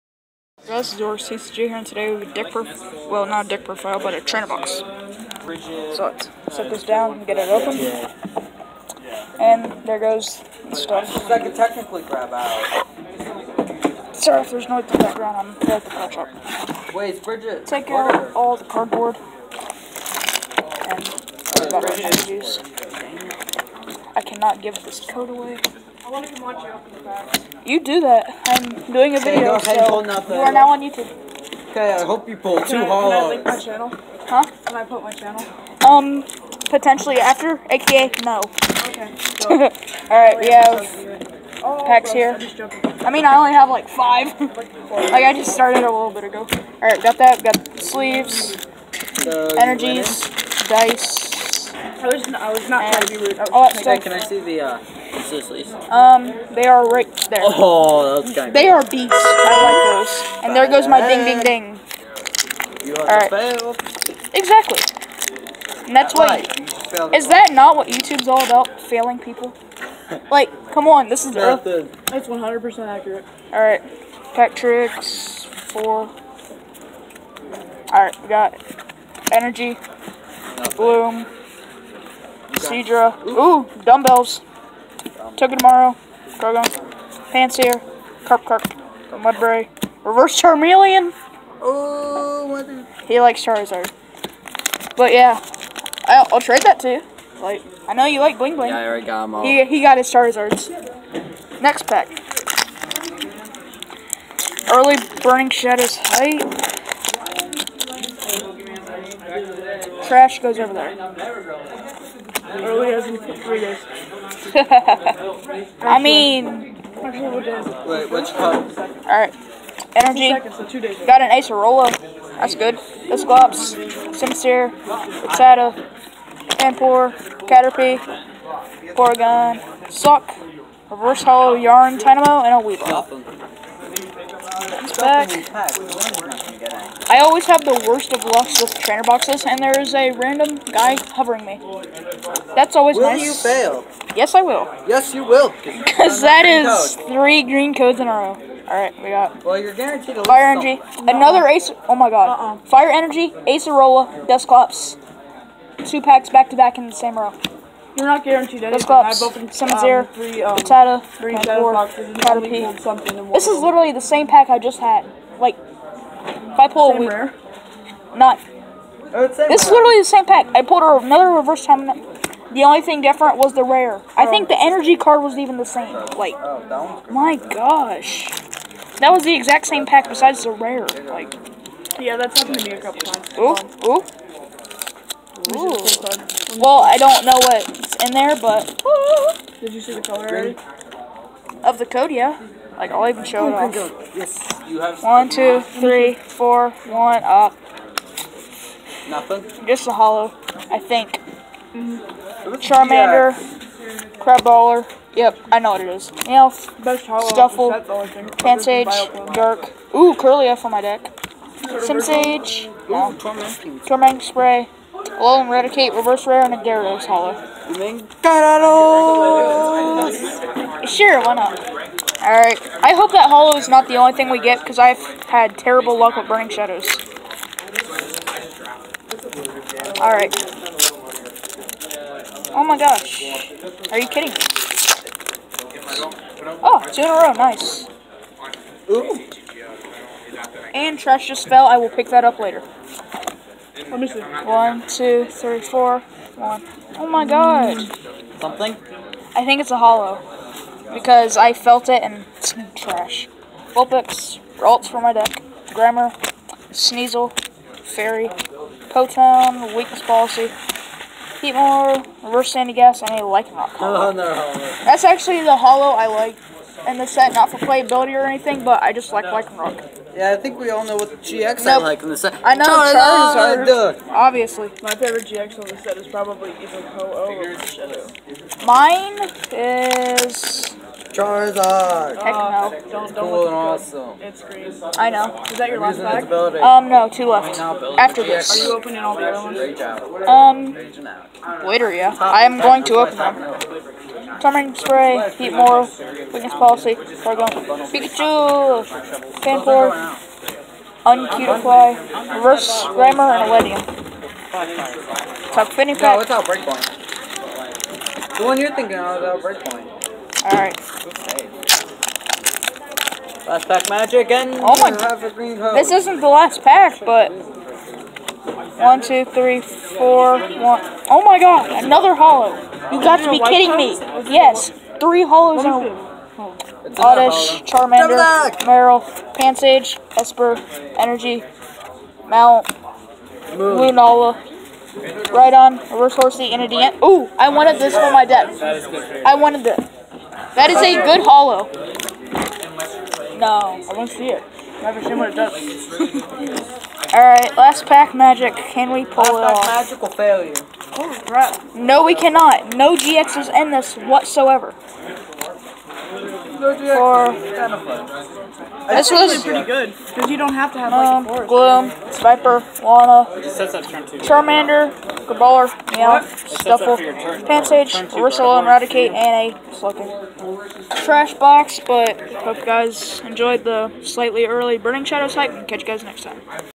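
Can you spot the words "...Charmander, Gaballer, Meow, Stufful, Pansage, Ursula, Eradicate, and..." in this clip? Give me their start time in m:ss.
6:04.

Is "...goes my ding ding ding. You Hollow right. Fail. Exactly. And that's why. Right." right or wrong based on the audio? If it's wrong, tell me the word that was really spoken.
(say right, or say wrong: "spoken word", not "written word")
wrong: "All", not "Hollow".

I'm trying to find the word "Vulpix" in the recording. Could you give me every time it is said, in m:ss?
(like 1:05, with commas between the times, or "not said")
4:13.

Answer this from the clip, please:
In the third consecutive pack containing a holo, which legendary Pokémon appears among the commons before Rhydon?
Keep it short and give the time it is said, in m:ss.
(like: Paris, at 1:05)
Lunala, at 5:33.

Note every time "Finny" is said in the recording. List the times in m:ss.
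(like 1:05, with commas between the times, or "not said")
5:05.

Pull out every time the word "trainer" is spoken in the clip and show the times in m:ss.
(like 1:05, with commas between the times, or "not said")
0:04, 2:18.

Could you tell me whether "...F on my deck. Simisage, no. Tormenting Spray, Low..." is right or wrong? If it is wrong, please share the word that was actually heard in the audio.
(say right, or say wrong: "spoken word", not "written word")
right.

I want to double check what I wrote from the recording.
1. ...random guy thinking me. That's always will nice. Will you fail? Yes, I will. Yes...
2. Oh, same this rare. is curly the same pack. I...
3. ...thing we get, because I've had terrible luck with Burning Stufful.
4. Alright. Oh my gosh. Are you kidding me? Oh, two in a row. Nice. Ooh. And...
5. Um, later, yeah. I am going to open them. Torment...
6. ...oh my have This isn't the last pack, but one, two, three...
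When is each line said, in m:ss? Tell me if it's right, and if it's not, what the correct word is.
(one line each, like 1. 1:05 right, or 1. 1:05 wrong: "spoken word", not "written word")
1. 2:20 wrong: "hovering", not "thinking"
2. 2:49 wrong: "literally", not "curly"
3. 3:44 wrong: "Shadows", not "Stufful"
4. 3:49 right
5. 4:50 right
6. 5:14 right.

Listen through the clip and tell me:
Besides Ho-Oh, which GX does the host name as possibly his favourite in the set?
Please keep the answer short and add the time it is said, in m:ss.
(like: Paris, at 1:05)
Shadow, at 4:37.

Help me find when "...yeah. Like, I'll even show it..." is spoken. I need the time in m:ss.
3:12.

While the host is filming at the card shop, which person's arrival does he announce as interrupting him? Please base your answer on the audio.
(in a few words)
Bridget.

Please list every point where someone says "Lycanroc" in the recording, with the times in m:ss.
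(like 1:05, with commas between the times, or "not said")
4:23, 4:29.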